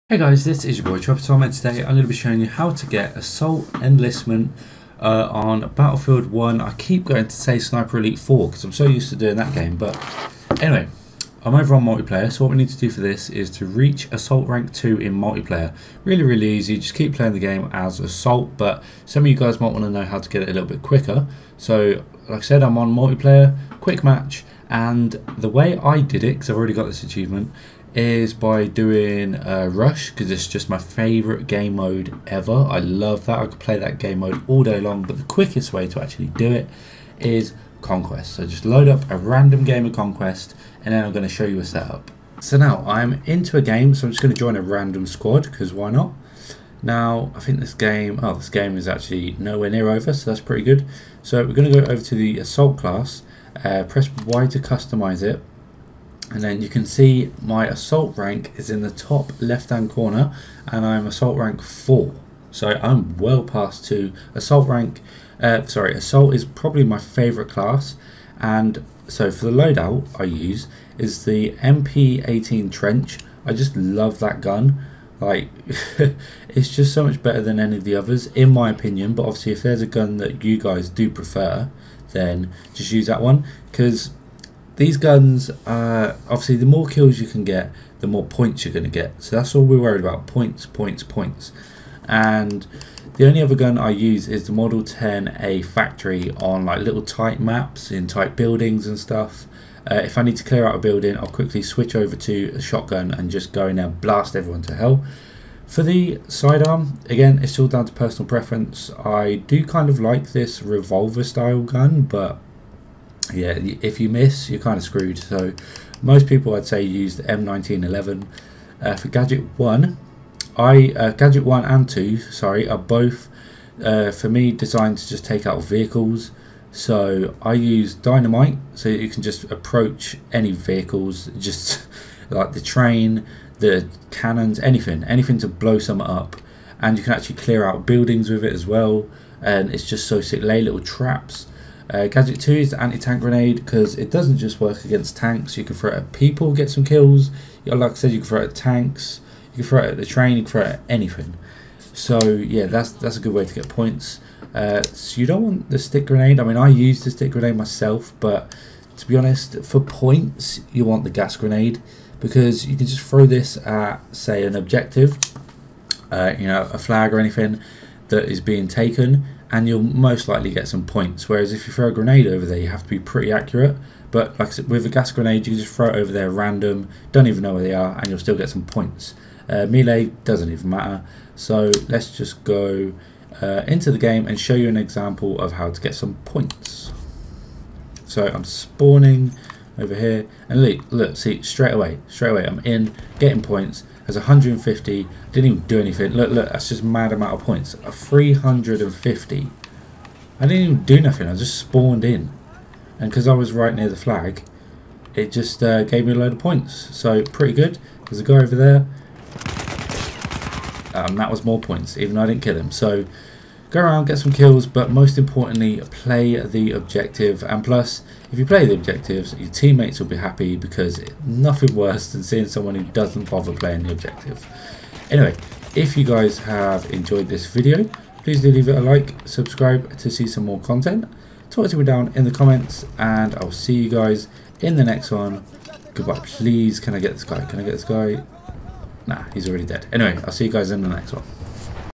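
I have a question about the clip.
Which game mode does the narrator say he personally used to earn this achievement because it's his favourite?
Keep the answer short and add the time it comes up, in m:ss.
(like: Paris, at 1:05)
Rush, at 0:29.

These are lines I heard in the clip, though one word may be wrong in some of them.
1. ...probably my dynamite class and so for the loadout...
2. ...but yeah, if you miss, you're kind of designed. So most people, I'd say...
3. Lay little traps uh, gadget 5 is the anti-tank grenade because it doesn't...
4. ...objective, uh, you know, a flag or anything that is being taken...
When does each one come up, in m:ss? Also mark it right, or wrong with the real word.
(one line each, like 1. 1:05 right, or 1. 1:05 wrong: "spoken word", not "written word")
1. 1:06 wrong: "favorite", not "dynamite"
2. 1:52 wrong: "screwed", not "designed"
3. 2:20 wrong: "2", not "5"
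4. 2:44 right.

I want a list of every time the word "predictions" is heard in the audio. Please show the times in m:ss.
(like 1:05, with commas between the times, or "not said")
not said.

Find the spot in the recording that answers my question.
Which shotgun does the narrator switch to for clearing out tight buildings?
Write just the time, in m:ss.
1:34.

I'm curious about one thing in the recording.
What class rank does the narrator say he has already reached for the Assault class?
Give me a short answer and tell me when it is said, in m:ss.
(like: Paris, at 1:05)
4, at 1:01.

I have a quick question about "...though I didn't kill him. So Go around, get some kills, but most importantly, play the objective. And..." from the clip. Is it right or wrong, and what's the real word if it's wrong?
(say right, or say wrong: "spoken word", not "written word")
right.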